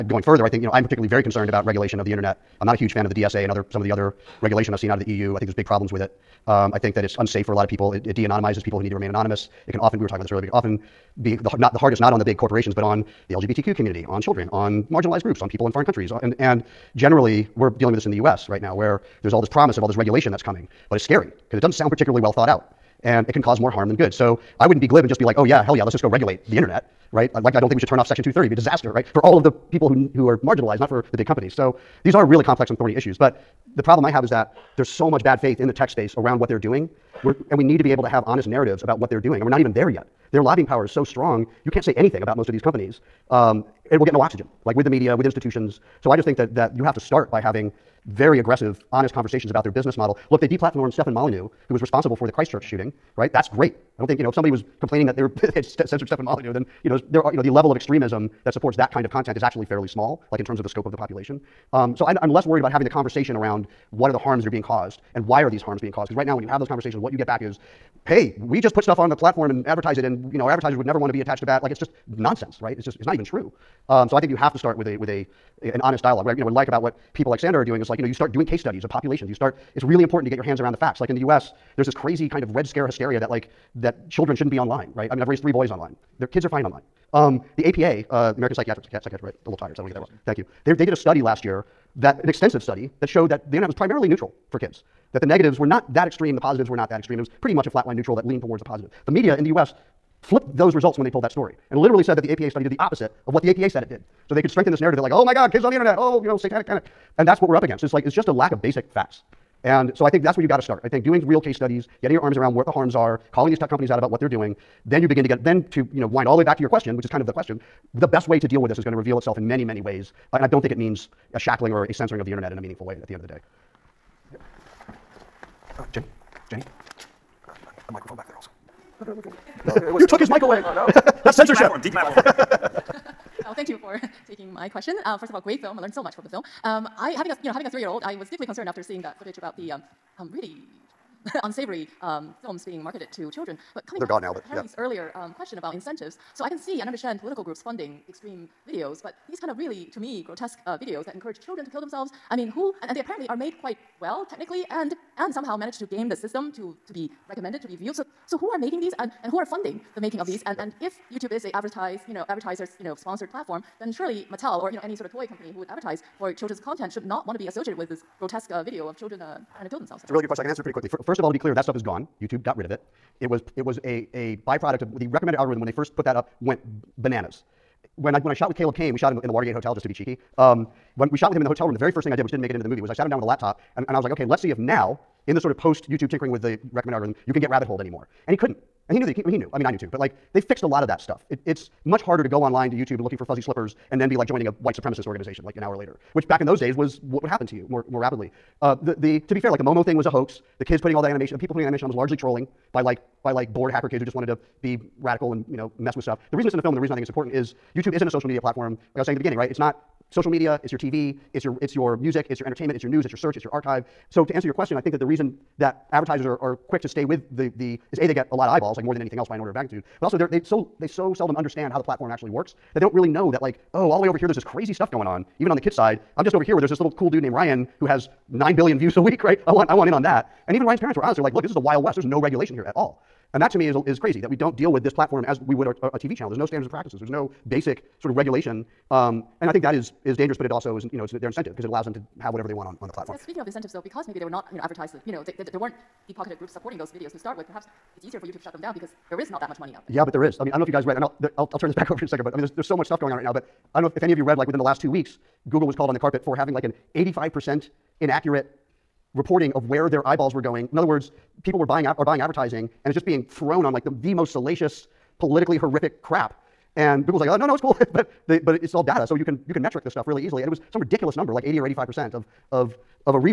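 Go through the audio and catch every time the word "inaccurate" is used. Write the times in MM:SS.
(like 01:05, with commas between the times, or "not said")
04:18.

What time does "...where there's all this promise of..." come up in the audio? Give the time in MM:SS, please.
00:18.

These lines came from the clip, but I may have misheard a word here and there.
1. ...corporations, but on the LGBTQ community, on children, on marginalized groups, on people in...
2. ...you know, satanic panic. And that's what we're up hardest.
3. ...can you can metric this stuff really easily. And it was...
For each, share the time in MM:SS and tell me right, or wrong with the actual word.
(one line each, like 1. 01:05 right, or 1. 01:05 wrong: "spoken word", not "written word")
1. 00:12 right
2. 01:46 wrong: "against", not "hardest"
3. 04:29 right.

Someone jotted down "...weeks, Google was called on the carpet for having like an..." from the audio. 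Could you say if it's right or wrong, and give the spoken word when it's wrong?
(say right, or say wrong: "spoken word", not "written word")
right.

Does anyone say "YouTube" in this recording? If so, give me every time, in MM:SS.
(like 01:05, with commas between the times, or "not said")
02:41, 02:52, 03:05, 03:12, 03:27.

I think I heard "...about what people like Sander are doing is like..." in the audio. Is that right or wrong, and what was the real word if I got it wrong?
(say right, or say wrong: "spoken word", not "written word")
right.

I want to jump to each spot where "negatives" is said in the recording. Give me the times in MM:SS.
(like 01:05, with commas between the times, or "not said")
01:35.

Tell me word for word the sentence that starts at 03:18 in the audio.
Uh, the, the, to be fair, like the Momo thing was a hoax.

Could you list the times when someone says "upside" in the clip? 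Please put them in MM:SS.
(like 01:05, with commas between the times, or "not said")
not said.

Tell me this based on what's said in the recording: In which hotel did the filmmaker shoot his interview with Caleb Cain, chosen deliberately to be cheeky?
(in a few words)
Watergate Hotel.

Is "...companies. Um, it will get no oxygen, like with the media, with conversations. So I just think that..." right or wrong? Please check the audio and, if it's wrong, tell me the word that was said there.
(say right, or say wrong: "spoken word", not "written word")
wrong: "institutions", not "conversations".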